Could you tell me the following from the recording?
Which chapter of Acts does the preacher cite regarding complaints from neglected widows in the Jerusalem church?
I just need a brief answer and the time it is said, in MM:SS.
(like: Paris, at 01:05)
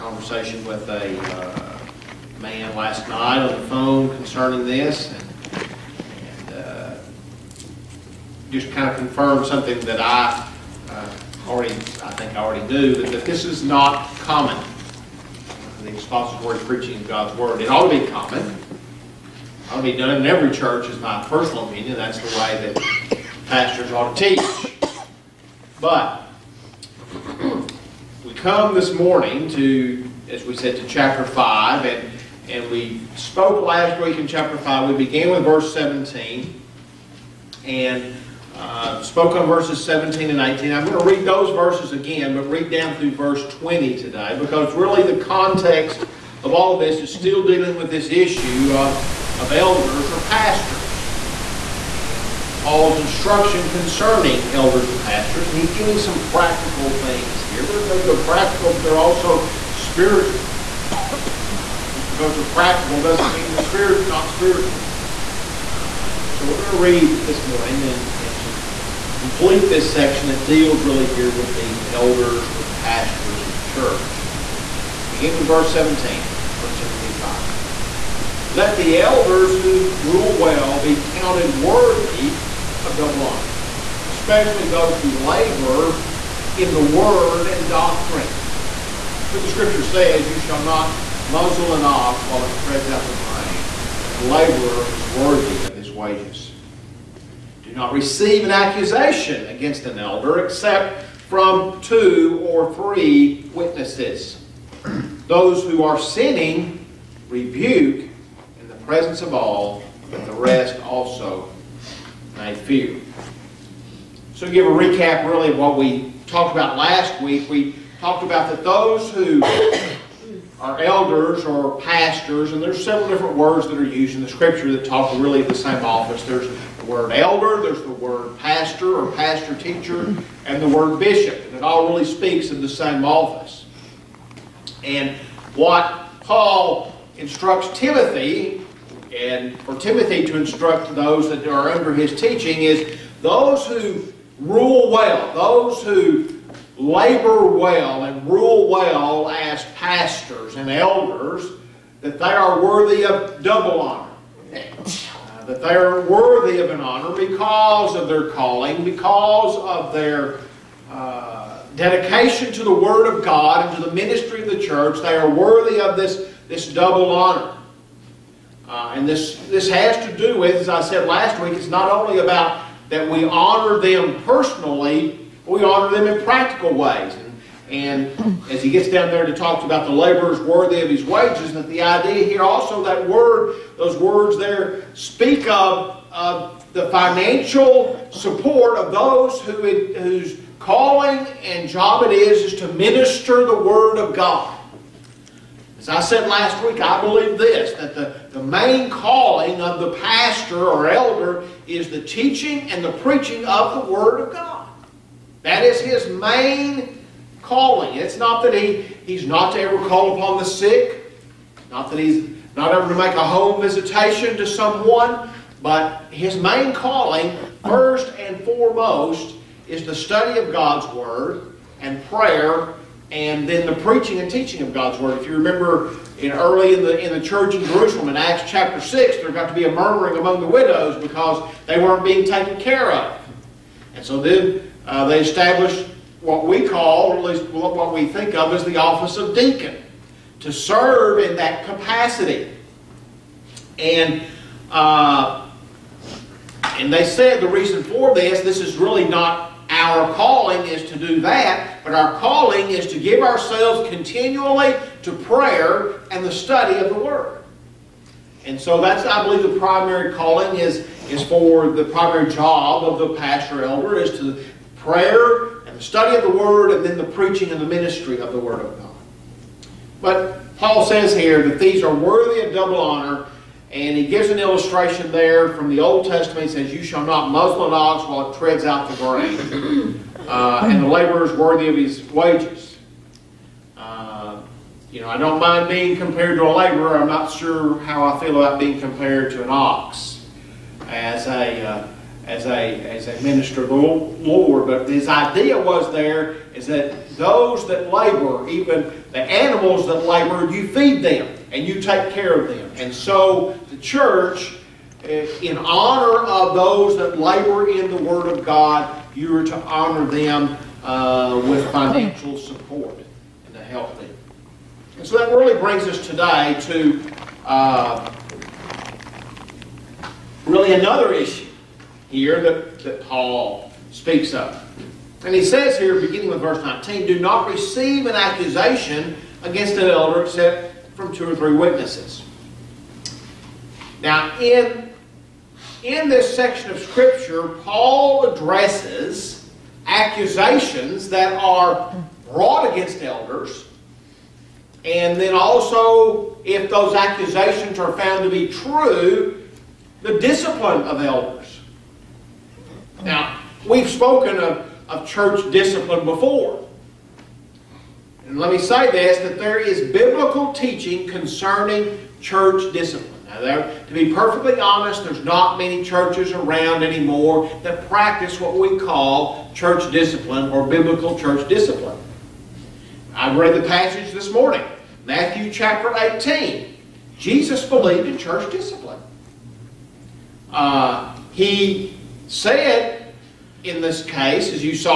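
Chapter 6, at 03:48.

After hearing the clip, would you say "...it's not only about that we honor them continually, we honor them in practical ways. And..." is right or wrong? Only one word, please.
wrong.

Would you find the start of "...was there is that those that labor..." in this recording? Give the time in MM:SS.
04:55.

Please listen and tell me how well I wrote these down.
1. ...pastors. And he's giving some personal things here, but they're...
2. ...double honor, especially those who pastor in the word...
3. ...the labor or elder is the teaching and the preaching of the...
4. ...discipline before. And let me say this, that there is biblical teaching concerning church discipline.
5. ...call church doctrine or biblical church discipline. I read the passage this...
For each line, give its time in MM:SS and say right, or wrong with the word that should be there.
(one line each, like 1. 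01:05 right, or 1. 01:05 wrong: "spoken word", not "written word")
1. 00:55 wrong: "practical", not "personal"
2. 01:22 wrong: "labor", not "pastor"
3. 03:19 wrong: "pastor", not "labor"
4. 05:55 right
5. 06:08 wrong: "discipline", not "doctrine".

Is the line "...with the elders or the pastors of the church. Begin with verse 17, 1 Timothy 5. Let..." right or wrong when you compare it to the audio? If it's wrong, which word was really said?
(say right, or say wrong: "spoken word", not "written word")
right.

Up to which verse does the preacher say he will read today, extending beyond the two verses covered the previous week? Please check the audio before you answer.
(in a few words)
Verse 20.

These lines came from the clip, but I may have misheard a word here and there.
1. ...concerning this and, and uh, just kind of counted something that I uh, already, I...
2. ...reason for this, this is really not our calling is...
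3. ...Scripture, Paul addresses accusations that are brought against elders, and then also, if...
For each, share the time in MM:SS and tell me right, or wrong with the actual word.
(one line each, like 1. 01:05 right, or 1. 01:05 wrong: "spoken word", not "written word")
1. 00:04 wrong: "confirmed", not "counted"
2. 04:07 right
3. 05:36 right.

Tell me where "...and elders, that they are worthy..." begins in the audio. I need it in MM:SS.
02:30.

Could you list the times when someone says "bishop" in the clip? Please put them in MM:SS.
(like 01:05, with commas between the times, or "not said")
02:11.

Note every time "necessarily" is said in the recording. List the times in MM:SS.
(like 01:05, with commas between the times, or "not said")
not said.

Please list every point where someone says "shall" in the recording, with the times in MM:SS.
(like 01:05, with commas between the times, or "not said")
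01:30, 04:36.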